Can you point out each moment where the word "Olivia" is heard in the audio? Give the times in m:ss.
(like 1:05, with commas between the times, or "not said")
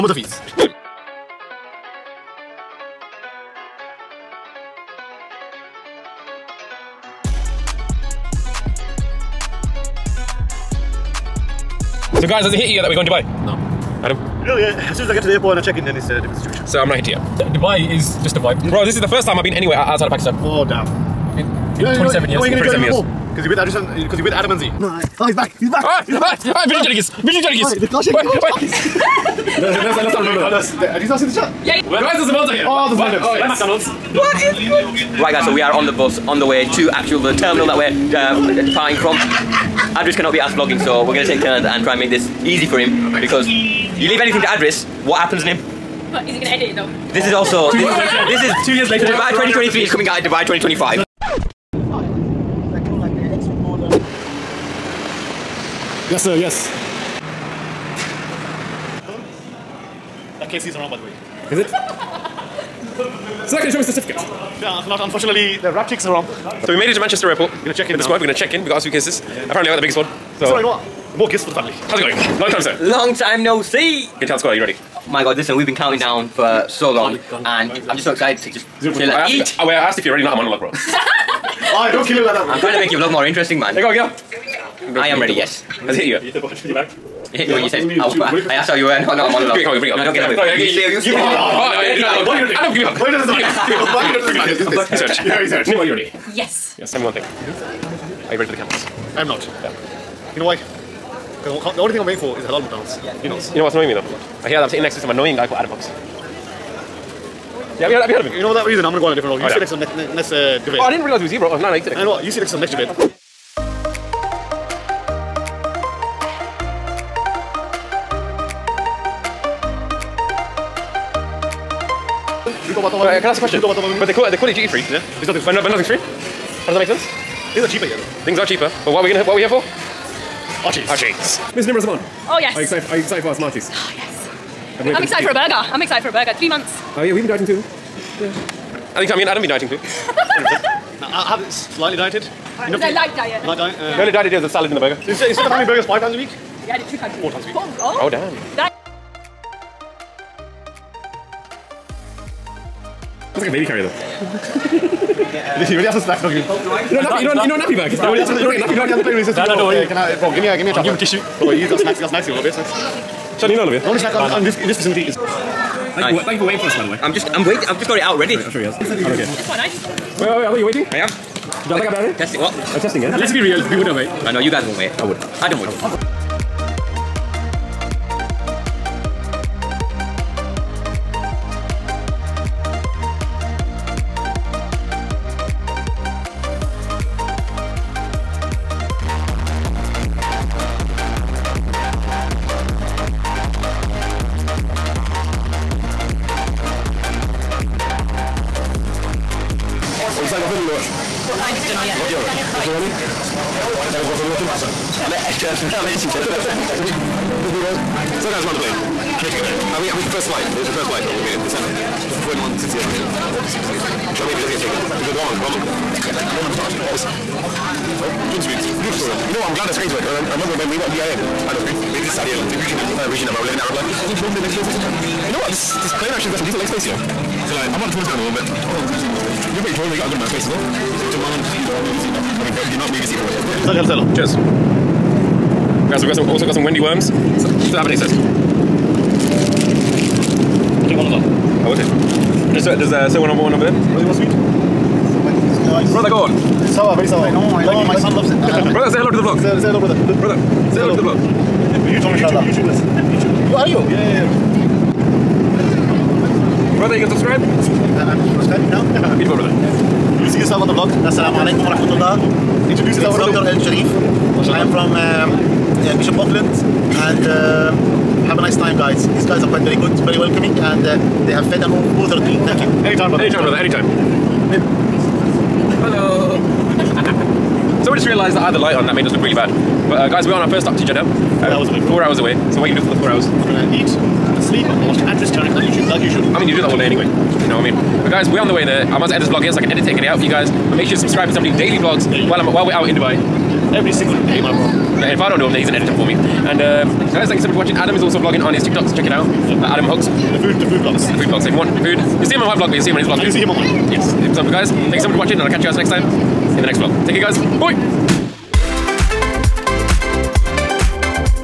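2:43.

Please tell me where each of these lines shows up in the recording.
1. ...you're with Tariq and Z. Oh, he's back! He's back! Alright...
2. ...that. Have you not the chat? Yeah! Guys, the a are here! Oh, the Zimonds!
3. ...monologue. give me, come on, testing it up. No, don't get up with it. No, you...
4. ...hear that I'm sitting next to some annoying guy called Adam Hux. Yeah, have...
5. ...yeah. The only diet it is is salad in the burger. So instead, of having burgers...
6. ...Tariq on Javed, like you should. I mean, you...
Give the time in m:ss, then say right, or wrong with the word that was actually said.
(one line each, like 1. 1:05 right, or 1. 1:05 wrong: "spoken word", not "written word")
1. 0:24 wrong: "Adam", not "Tariq"
2. 0:30 right
3. 1:29 wrong: "bring", not "testing"
4. 1:44 right
5. 2:23 right
6. 4:45 wrong: "YouTube", not "Javed".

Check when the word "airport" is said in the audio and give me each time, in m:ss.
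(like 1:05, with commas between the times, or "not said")
0:15, 1:07.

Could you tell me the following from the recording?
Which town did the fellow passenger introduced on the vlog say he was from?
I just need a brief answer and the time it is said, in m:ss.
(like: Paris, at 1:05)
Bishop Auckland, at 4:25.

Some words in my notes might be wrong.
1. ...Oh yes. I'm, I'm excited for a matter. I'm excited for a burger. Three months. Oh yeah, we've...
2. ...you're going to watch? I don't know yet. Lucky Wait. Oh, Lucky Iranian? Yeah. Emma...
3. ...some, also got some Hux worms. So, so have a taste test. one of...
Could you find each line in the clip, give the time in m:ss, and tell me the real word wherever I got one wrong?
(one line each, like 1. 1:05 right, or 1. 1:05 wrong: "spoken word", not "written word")
1. 2:13 wrong: "burger", not "matter"
2. 3:20 wrong: "Iranian", not "Wait"
3. 3:56 wrong: "Wendy", not "Hux".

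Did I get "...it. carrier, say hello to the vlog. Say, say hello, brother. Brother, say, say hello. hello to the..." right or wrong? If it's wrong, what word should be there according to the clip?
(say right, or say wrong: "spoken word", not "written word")
wrong: "brother", not "carrier".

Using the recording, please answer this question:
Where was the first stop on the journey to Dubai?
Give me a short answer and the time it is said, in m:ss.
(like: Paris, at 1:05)
Jeddah, at 4:40.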